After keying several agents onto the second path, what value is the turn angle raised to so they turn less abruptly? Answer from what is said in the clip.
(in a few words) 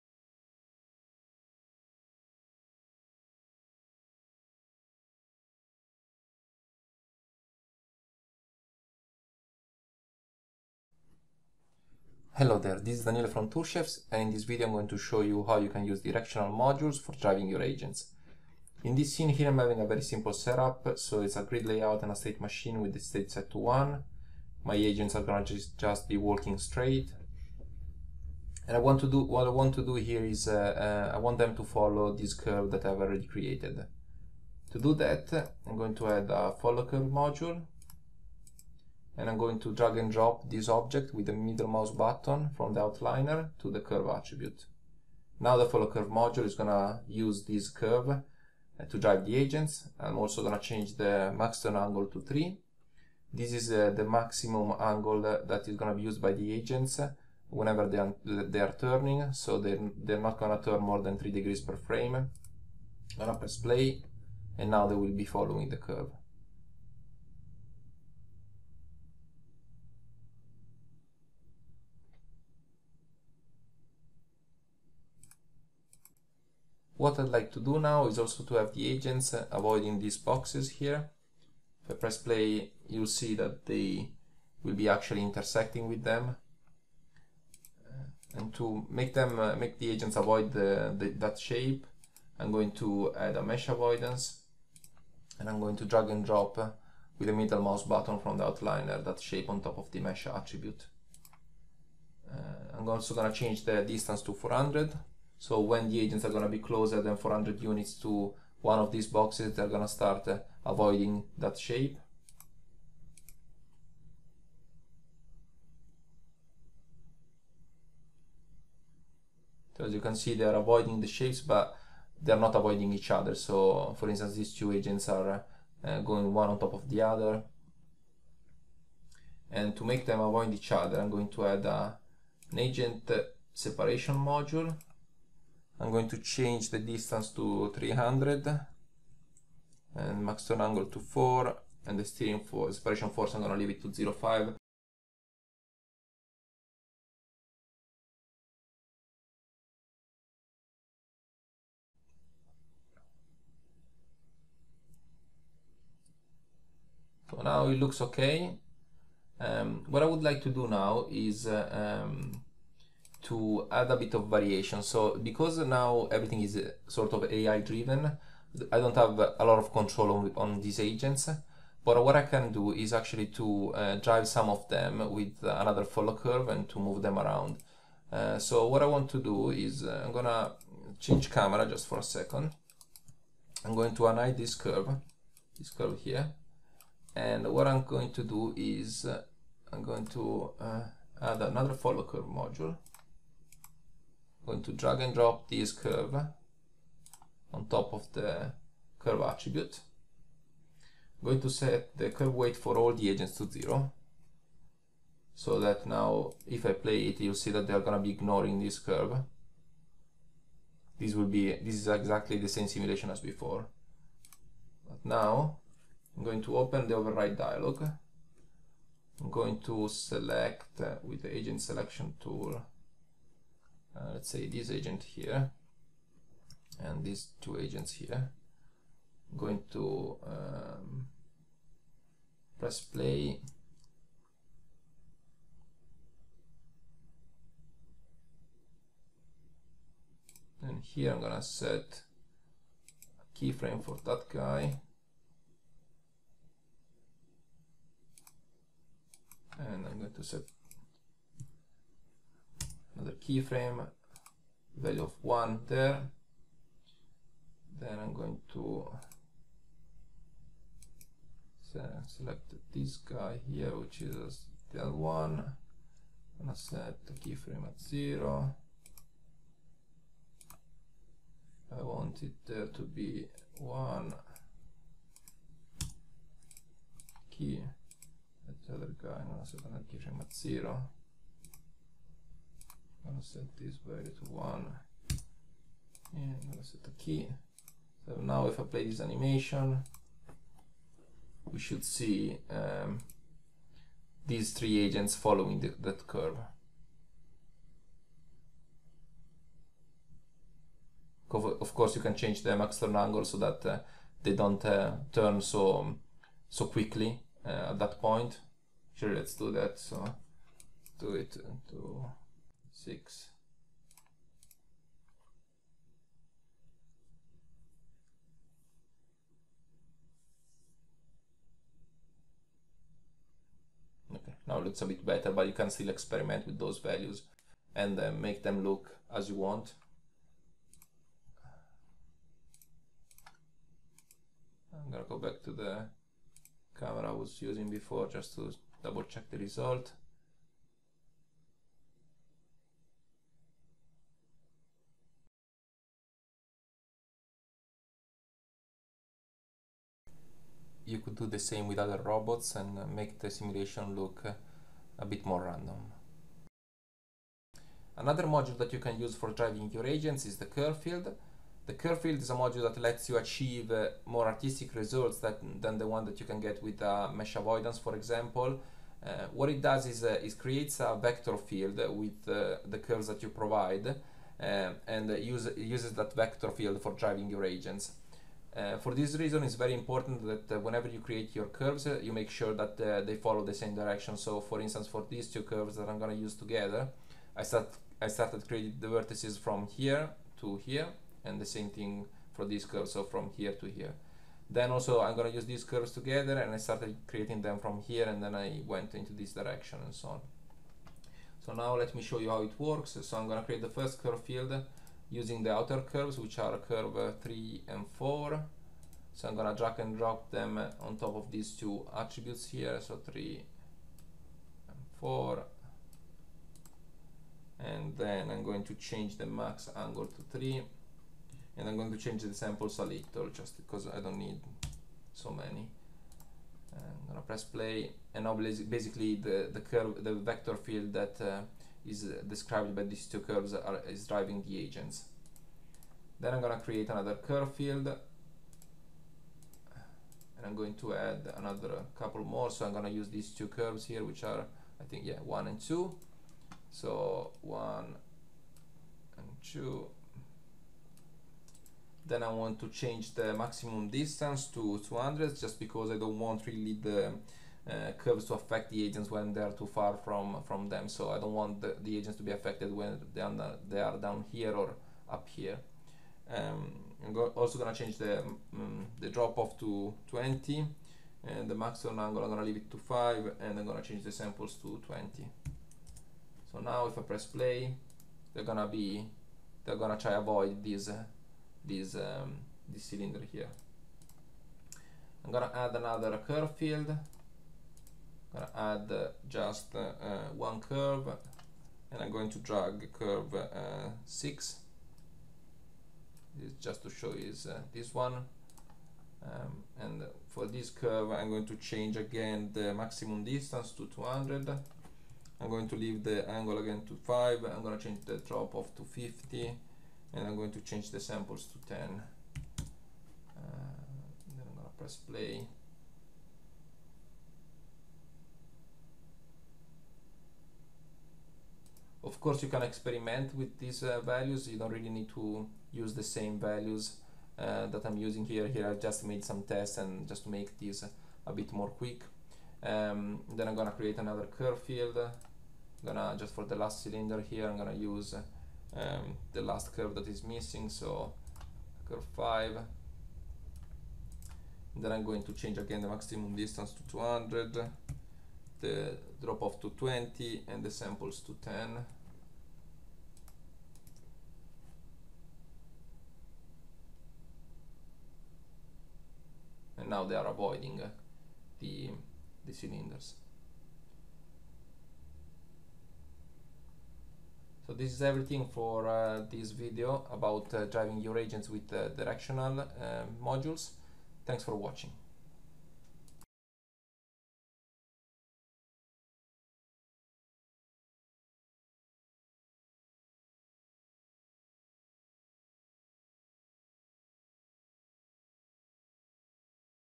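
6.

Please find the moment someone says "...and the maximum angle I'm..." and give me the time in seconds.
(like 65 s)
471 s.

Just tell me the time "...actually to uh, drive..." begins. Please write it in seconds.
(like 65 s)
172 s.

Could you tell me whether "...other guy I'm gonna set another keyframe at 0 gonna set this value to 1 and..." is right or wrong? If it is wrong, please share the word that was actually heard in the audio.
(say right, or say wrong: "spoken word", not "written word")
right.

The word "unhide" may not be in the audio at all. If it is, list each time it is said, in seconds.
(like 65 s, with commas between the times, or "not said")
184 s.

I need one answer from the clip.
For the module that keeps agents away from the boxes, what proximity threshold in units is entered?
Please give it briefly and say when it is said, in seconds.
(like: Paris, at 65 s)
400, at 103 s.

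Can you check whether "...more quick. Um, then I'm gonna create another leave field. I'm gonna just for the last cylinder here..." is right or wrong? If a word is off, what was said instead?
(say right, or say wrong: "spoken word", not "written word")
wrong: "curve", not "leave".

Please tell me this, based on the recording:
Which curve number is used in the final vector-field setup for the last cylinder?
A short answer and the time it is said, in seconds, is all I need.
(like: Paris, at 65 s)
5, at 541 s.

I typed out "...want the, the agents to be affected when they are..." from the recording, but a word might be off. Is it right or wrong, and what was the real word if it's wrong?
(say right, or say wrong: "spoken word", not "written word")
right.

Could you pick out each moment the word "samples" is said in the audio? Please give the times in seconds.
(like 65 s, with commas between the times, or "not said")
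422 s, 474 s, 511 s, 550 s.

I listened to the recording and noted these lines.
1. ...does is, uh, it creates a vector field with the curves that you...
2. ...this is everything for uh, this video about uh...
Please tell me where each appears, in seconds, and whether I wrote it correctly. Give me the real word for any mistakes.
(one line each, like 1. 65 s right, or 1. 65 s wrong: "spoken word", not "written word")
1. 369 s right
2. 567 s right.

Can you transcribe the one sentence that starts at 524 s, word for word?
You don't really need to use the same values uh, that I'm using here.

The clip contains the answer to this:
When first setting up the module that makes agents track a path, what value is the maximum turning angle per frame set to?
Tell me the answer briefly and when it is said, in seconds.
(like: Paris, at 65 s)
3, at 50 s.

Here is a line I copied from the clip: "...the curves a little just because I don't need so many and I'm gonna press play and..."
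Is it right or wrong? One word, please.
wrong.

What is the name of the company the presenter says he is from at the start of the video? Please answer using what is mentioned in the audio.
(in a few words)
Toolchefs.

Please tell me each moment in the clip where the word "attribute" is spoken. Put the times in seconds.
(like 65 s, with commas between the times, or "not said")
44 s, 100 s, 199 s, 411 s.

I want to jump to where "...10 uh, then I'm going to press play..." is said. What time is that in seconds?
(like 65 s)
511 s.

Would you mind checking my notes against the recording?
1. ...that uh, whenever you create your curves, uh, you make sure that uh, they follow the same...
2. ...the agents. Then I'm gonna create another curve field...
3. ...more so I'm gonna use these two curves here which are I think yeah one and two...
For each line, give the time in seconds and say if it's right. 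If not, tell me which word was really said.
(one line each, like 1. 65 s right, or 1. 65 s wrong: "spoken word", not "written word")
1. 380 s right
2. 434 s right
3. 442 s right.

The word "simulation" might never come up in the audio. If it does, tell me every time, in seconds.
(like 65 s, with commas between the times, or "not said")
212 s, 353 s.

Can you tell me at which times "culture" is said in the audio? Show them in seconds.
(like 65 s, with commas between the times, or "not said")
not said.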